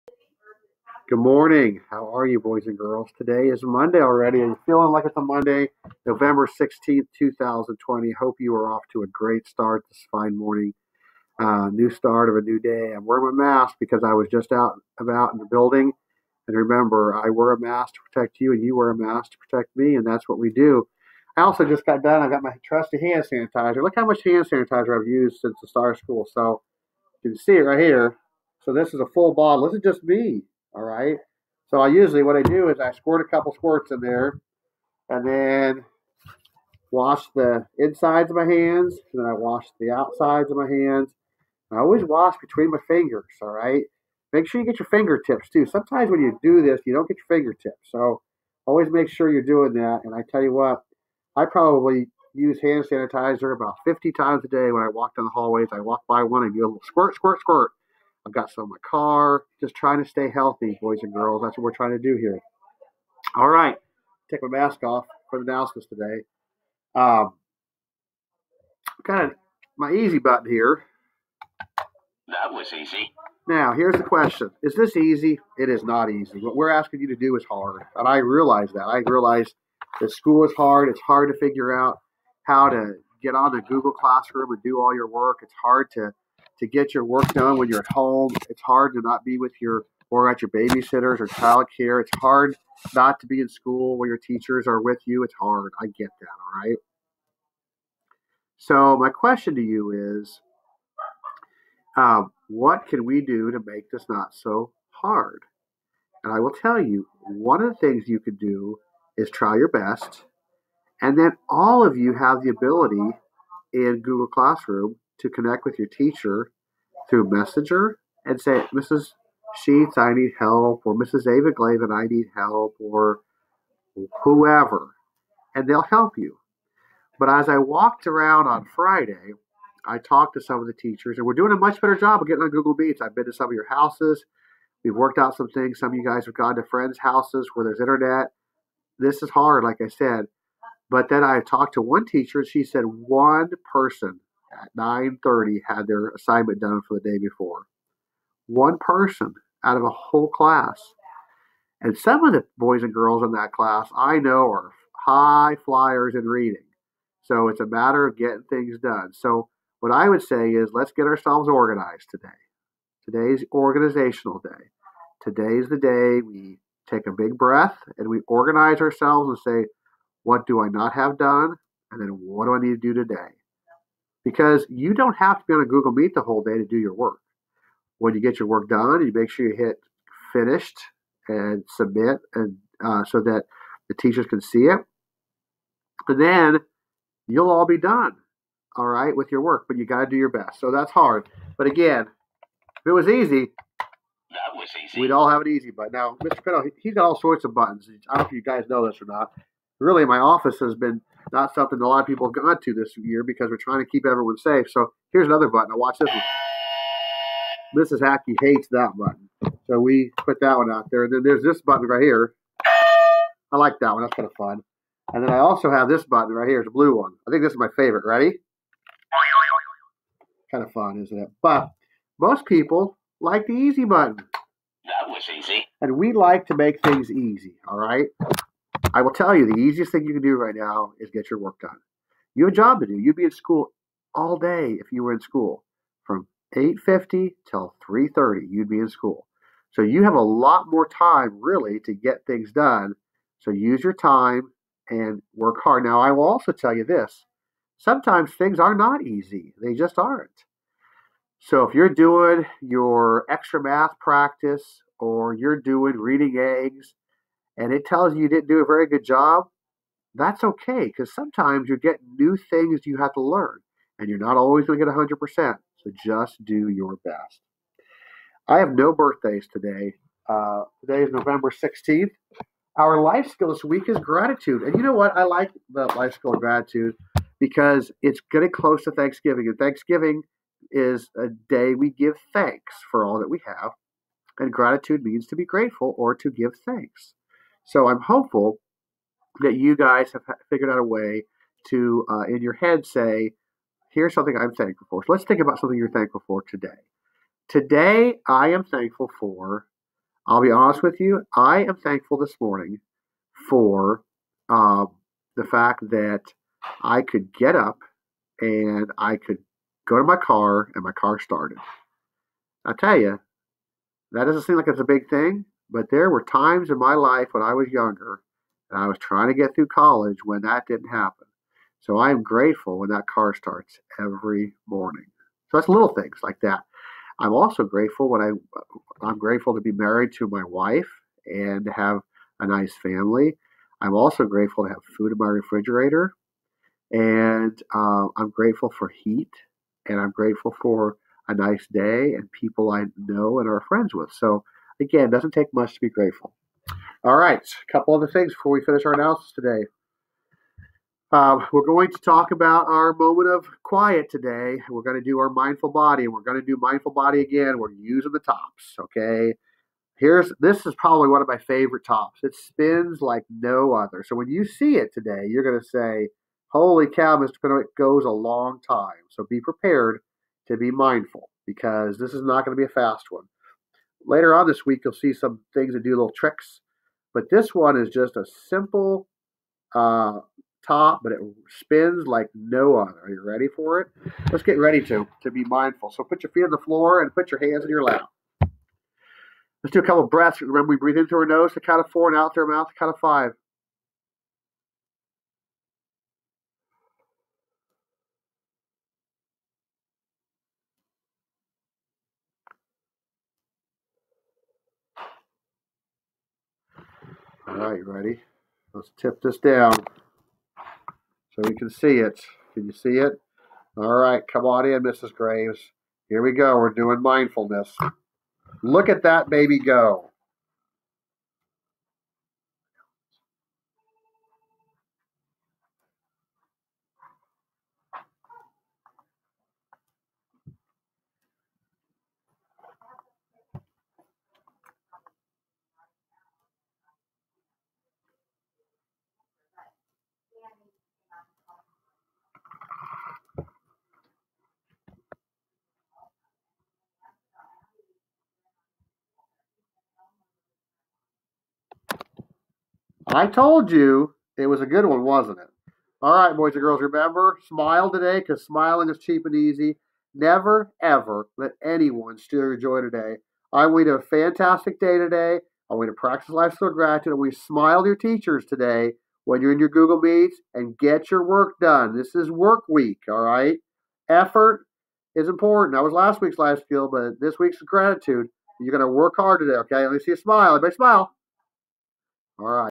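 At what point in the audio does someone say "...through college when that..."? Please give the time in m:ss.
5:19.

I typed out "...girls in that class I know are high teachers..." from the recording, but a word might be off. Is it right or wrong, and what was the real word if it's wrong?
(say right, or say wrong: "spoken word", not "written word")
wrong: "flyers", not "teachers".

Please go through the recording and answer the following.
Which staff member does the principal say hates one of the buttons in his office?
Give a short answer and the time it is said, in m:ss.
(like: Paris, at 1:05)
Mrs. Hackey, at 3:27.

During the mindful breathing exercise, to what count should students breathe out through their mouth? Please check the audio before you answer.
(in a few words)
5.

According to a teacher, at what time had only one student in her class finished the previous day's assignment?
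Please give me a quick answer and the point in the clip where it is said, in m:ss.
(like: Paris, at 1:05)
9:30, at 2:24.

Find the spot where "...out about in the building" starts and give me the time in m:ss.
0:14.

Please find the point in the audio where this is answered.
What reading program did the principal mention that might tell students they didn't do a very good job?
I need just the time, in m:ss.
4:15.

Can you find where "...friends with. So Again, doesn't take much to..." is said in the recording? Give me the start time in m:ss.
5:43.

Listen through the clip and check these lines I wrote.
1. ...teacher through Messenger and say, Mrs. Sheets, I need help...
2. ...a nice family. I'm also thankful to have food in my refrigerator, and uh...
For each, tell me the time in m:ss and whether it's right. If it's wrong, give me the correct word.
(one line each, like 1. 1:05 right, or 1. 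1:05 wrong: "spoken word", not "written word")
1. 1:55 right
2. 5:32 wrong: "grateful", not "thankful".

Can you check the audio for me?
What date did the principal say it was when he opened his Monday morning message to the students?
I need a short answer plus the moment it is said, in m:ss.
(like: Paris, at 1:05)
November 16th, 2020, at 0:06.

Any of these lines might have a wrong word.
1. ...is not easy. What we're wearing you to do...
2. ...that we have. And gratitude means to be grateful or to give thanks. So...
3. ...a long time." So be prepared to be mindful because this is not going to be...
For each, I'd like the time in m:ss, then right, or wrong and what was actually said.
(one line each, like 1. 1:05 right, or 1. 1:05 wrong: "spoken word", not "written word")
1. 1:15 wrong: "asking", not "wearing"
2. 4:43 right
3. 6:08 right.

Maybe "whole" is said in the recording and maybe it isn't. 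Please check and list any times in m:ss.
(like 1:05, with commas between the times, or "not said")
2:29, 2:56.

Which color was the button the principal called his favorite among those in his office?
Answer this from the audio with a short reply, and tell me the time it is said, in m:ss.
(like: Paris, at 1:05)
Blue, at 3:36.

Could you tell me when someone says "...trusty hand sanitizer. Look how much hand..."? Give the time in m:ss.
0:22.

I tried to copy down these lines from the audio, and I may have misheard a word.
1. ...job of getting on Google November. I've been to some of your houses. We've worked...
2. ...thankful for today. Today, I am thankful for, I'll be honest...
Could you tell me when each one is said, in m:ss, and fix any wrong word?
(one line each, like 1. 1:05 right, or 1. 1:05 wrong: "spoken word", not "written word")
1. 2:11 wrong: "Meets", not "November"
2. 4:55 right.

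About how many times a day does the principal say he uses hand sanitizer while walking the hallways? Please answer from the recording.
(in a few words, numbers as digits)
50.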